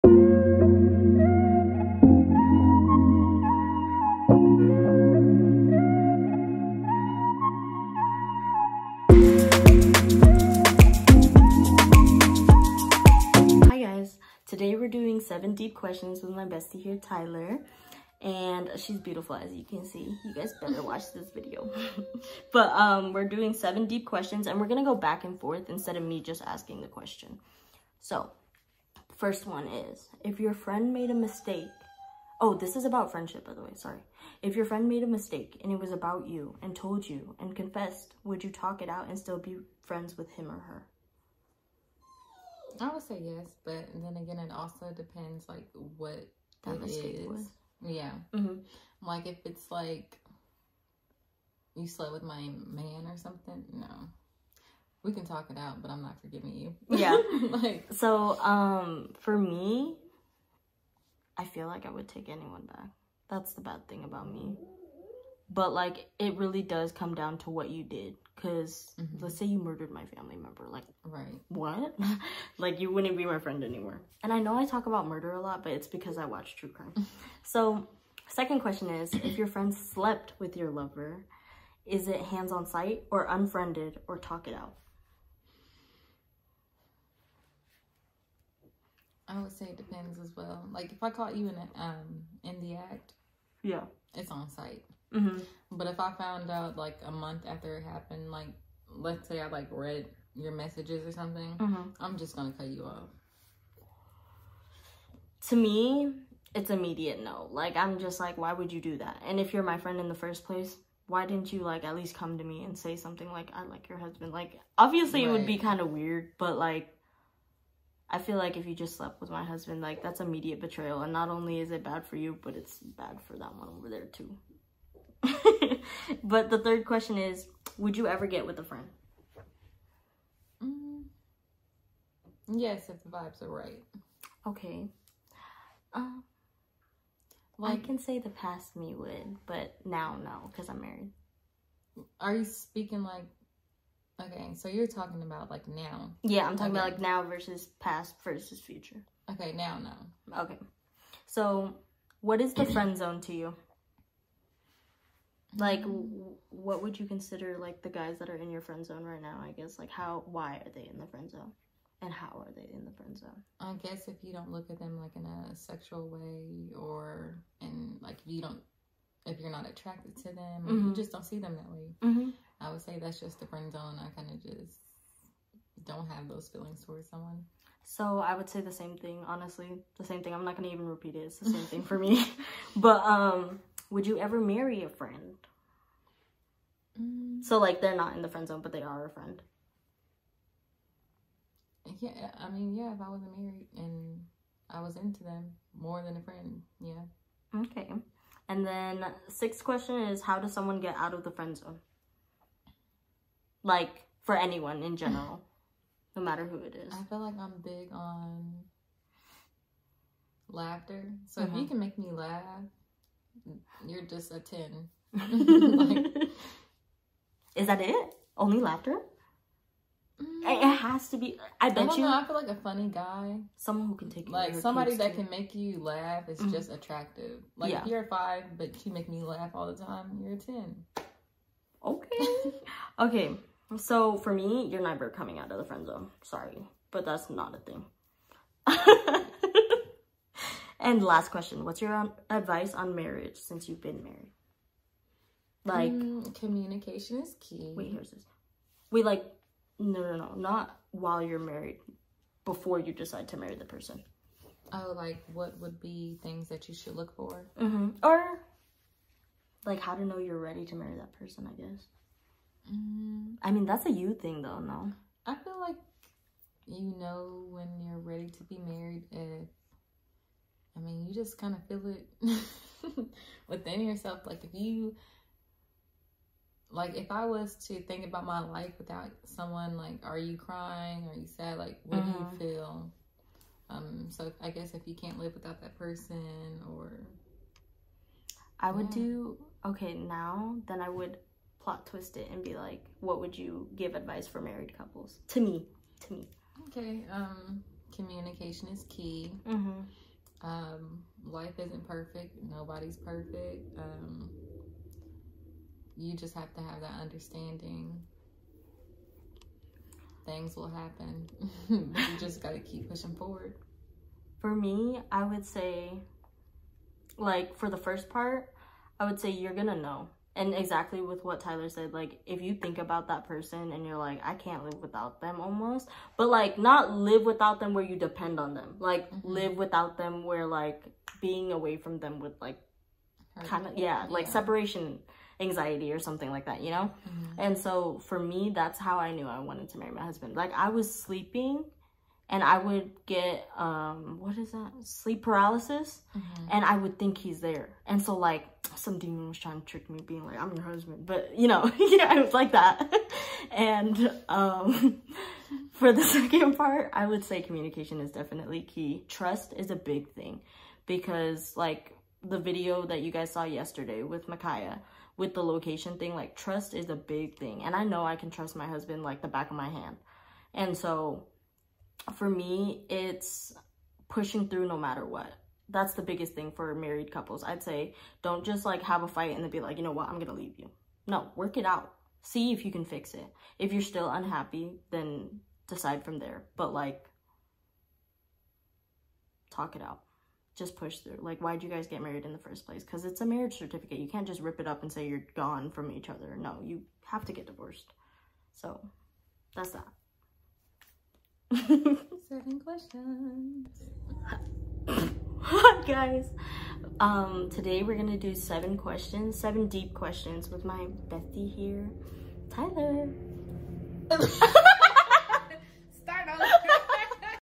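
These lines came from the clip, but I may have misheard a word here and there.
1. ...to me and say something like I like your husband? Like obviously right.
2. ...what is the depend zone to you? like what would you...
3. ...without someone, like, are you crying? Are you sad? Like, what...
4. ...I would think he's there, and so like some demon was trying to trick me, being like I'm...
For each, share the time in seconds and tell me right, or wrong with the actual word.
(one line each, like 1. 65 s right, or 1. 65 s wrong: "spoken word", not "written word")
1. 112 s right
2. 152 s wrong: "friend", not "depend"
3. 278 s right
4. 346 s right.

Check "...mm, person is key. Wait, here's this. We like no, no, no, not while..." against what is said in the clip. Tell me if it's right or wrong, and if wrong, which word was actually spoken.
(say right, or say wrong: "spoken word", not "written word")
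wrong: "communication", not "person".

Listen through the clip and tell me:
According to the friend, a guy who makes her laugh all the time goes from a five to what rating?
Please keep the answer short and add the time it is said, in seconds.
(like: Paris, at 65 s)
10, at 230 s.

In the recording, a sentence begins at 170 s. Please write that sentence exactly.
you just don't see them that way mm-hmm.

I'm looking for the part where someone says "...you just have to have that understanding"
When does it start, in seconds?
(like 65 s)
305 s.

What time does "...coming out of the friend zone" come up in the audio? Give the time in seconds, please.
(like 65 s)
235 s.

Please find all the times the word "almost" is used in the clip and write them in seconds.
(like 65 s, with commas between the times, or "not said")
325 s.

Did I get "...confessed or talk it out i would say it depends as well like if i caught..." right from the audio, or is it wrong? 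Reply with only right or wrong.
wrong.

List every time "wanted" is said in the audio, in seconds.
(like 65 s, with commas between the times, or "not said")
339 s.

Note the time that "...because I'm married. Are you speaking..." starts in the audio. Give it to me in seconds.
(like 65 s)
140 s.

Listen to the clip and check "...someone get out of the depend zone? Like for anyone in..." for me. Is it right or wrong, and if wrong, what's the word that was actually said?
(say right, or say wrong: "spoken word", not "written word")
wrong: "friend", not "depend".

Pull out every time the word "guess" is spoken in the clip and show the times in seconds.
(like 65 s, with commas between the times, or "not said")
159 s, 163 s, 261 s, 284 s.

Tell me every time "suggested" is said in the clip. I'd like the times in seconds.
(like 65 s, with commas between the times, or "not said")
not said.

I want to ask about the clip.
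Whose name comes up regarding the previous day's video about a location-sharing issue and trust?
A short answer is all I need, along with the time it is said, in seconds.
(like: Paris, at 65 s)
Micaiah, at 364 s.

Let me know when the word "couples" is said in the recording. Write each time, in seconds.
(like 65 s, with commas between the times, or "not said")
294 s, 377 s.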